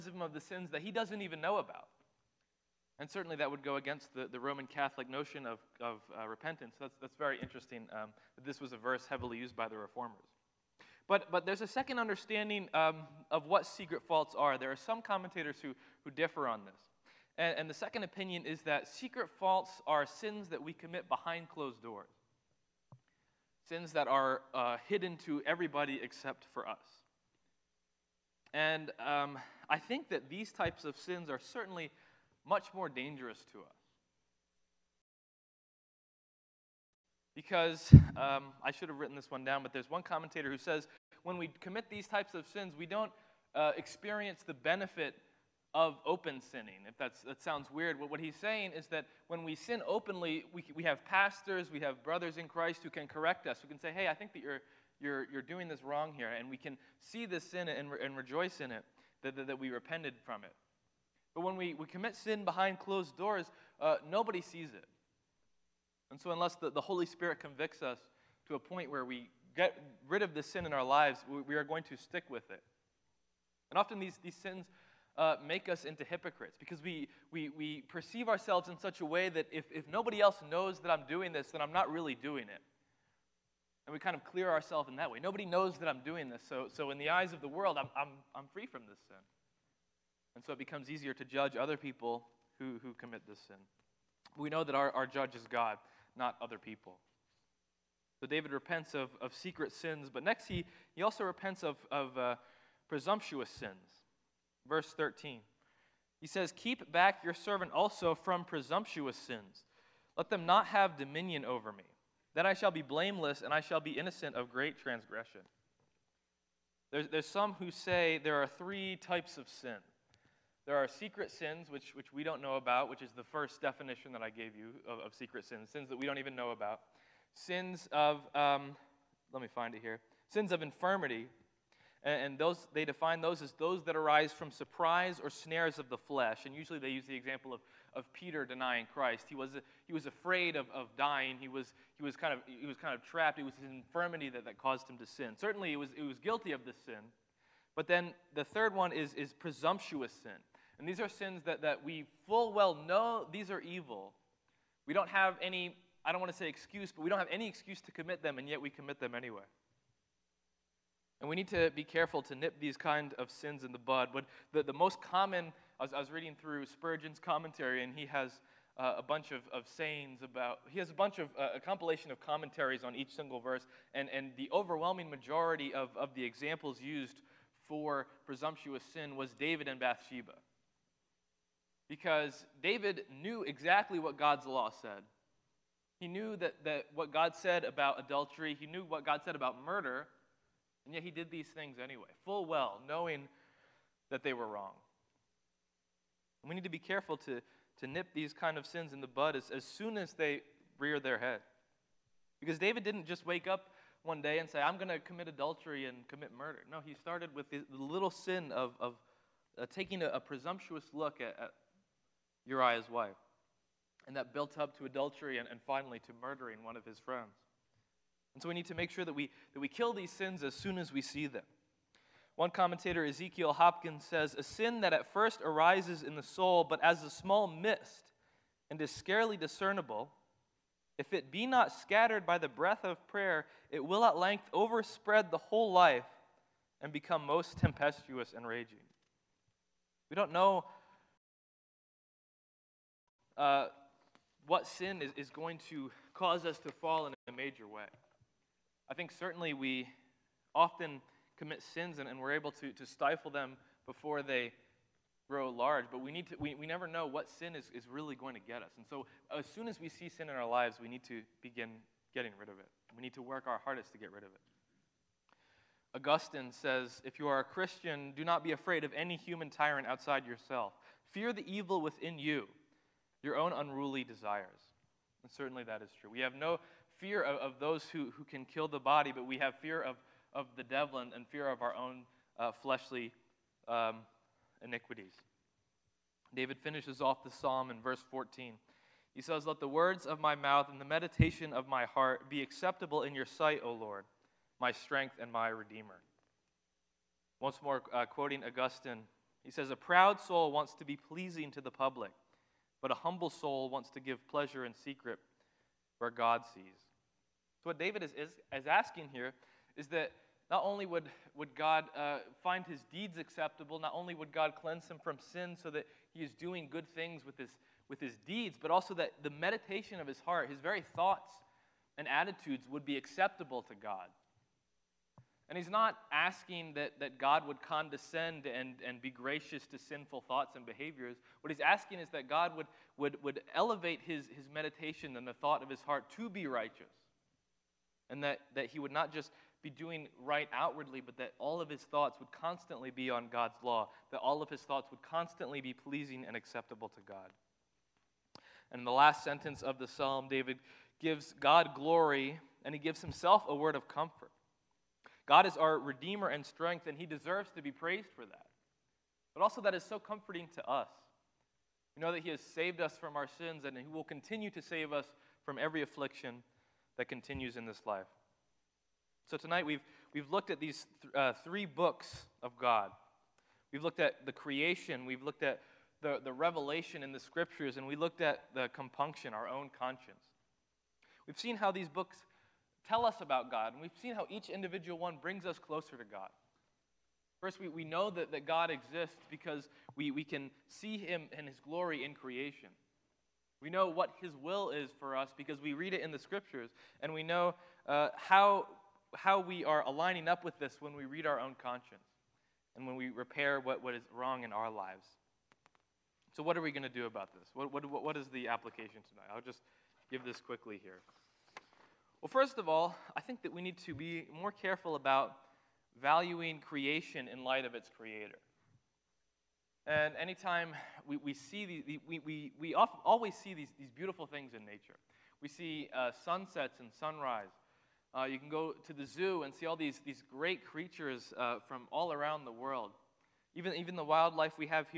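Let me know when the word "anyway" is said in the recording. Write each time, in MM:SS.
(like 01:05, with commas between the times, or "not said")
02:39, 03:11.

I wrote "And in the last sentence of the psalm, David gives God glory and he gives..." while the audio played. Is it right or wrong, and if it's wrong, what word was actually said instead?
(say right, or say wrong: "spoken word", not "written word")
right.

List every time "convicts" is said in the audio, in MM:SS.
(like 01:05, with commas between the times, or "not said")
01:07.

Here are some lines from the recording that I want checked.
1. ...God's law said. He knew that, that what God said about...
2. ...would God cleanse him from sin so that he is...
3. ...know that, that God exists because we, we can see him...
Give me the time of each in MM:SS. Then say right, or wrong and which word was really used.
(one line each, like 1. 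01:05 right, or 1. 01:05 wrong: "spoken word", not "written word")
1. 03:04 right
2. 05:14 right
3. 06:27 right.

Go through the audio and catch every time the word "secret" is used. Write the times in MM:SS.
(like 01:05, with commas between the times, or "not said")
00:13, 00:18, 01:39, 02:00, 02:05, 05:04.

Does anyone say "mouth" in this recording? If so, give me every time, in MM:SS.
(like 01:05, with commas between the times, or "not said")
04:50.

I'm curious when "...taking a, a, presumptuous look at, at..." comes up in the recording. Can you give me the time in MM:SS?
03:29.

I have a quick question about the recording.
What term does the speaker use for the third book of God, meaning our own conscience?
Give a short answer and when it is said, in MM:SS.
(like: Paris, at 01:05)
compunction, at 06:18.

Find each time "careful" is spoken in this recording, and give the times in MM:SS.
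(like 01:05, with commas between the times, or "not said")
02:41, 03:16, 06:54.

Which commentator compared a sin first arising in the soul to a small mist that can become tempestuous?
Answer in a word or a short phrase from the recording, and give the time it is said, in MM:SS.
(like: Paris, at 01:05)
Ezekiel Hopkins, at 03:43.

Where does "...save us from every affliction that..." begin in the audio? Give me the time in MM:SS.
06:04.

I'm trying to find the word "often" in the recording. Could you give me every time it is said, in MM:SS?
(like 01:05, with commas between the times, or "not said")
01:13, 04:10.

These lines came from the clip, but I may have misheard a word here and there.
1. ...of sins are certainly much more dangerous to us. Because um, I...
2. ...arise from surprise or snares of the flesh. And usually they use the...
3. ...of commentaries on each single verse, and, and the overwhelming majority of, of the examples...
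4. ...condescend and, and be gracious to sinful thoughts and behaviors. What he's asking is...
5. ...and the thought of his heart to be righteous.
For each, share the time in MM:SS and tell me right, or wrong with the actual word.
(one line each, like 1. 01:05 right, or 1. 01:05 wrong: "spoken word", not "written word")
1. 00:30 right
2. 02:13 right
3. 02:52 right
4. 05:27 right
5. 05:35 right.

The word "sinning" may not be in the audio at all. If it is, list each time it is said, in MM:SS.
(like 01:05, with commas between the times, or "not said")
00:46.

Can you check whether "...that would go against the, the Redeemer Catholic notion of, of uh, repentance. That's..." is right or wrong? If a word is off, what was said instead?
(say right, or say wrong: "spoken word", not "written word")
wrong: "Roman", not "Redeemer".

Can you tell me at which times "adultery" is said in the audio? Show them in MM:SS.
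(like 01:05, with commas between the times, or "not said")
03:07, 03:25, 03:34.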